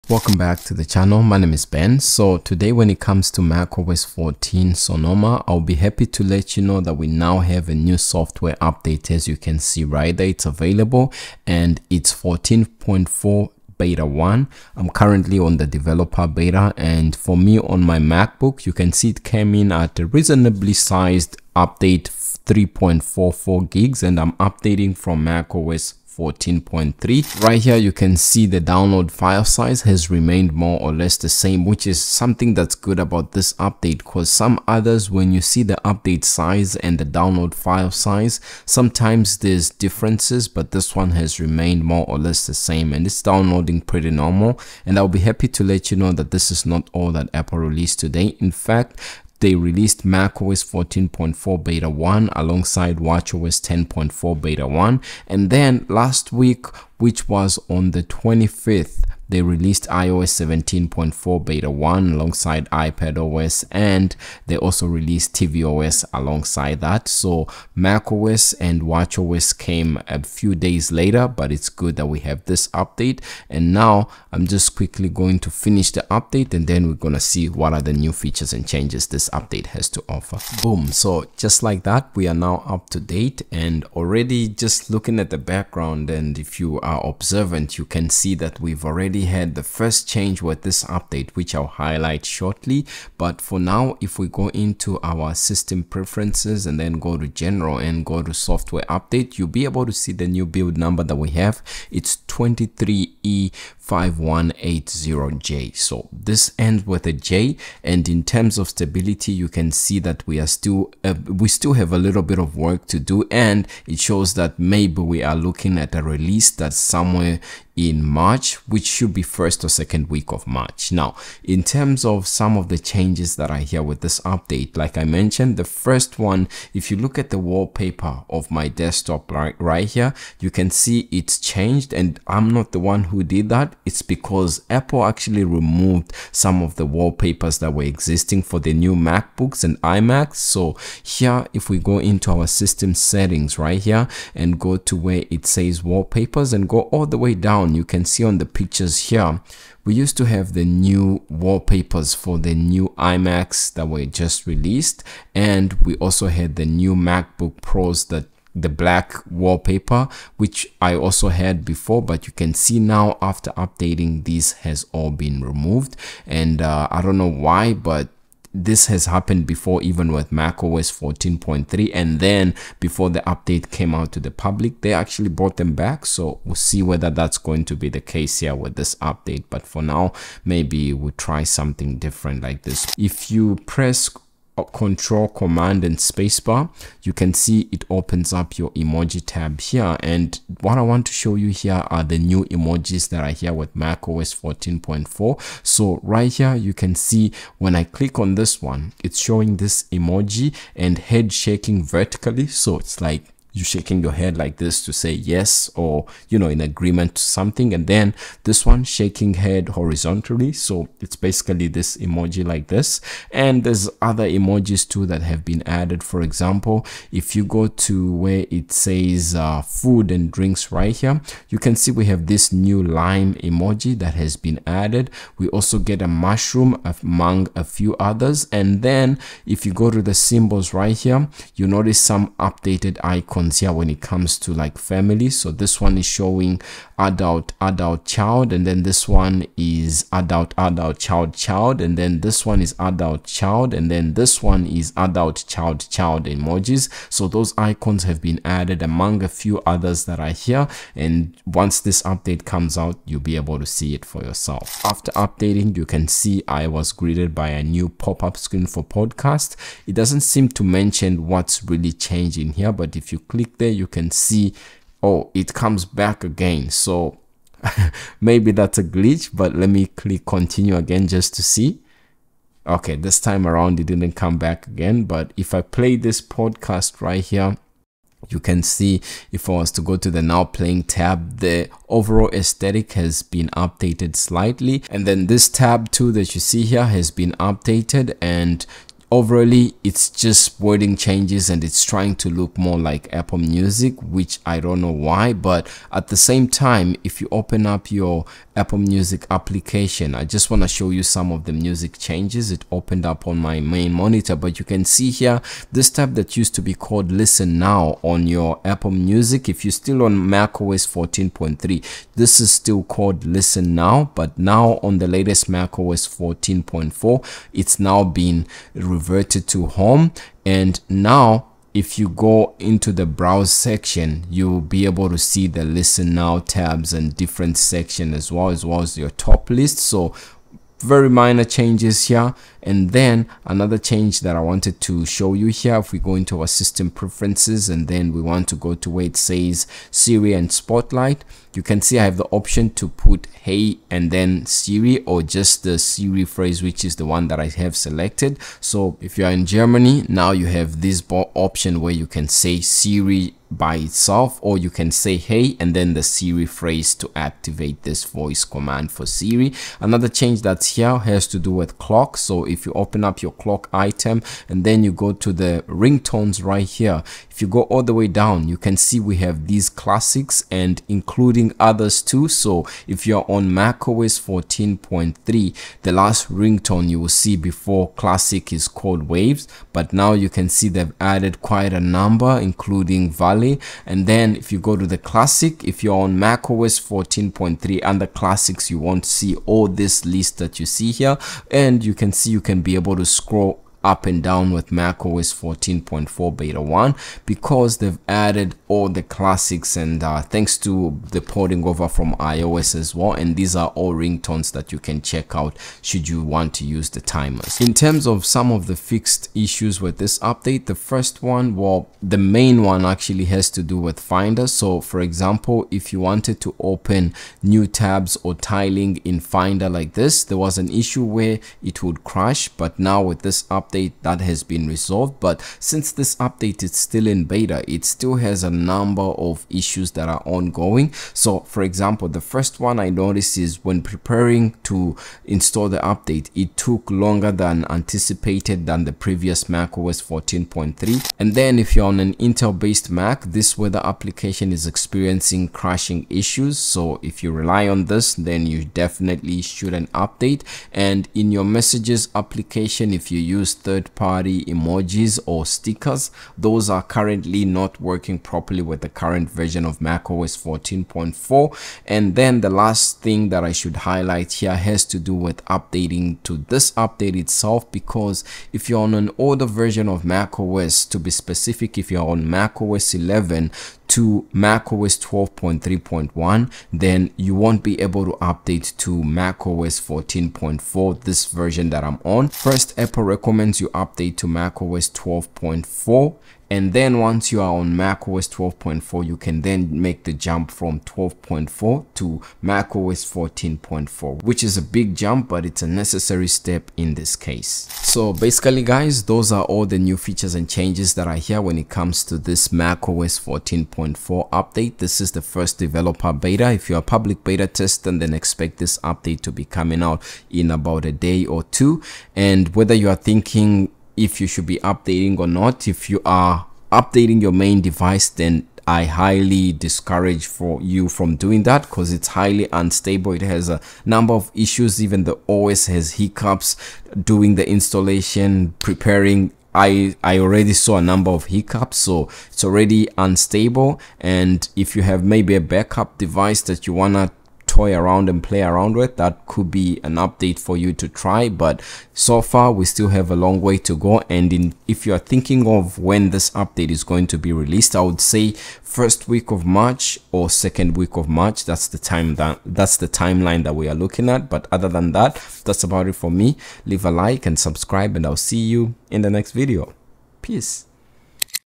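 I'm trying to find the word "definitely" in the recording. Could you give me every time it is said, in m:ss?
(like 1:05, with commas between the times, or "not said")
7:28.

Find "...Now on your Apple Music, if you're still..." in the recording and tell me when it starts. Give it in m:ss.
5:07.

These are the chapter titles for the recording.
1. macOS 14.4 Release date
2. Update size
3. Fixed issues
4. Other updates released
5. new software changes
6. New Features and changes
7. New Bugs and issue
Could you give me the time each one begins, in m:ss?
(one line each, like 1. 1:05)
1. 8:18
2. 0:20
3. 6:47
4. 0:42
5. 1:20
6. 2:00
7. 7:07.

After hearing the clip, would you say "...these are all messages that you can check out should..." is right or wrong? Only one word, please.
wrong.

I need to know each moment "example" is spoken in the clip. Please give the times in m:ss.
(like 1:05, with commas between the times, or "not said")
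3:36, 6:55, 7:11.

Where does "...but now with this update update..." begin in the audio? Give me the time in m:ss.
7:02.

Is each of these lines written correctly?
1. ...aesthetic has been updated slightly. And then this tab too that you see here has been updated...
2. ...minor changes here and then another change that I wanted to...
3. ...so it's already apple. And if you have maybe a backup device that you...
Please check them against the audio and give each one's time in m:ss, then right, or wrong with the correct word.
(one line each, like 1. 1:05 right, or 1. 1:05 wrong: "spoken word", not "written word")
1. 4:42 right
2. 5:31 right
3. 8:51 wrong: "unstable", not "apple".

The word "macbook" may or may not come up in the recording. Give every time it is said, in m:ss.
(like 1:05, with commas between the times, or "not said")
0:17, 2:18, 2:36.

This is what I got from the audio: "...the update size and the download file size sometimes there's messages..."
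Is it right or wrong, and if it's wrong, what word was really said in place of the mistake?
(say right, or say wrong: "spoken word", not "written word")
wrong: "differences", not "messages".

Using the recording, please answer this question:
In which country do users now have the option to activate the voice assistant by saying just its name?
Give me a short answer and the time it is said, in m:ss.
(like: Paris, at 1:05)
Germany, at 5:49.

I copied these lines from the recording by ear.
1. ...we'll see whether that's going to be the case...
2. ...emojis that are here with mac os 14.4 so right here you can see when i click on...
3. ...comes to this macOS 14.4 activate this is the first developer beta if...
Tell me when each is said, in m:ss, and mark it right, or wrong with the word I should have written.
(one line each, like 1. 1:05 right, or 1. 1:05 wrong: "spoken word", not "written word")
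1. 2:56 right
2. 3:12 right
3. 8:21 wrong: "update", not "activate".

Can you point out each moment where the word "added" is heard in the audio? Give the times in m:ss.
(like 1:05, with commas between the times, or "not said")
3:35, 3:44, 4:08, 6:21, 6:38.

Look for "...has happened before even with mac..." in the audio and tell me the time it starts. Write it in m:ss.
2:48.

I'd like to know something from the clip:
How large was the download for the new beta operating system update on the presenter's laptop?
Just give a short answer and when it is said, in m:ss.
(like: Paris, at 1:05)
3.44 GB, at 0:22.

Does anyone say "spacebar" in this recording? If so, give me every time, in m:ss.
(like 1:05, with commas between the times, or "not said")
3:05.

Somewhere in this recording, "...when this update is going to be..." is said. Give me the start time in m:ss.
9:05.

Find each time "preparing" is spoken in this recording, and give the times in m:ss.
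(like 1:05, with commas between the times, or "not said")
7:13, 8:48.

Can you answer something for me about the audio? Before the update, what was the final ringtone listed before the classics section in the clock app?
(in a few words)
Waves.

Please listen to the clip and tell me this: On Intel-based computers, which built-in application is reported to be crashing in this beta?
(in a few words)
Weather.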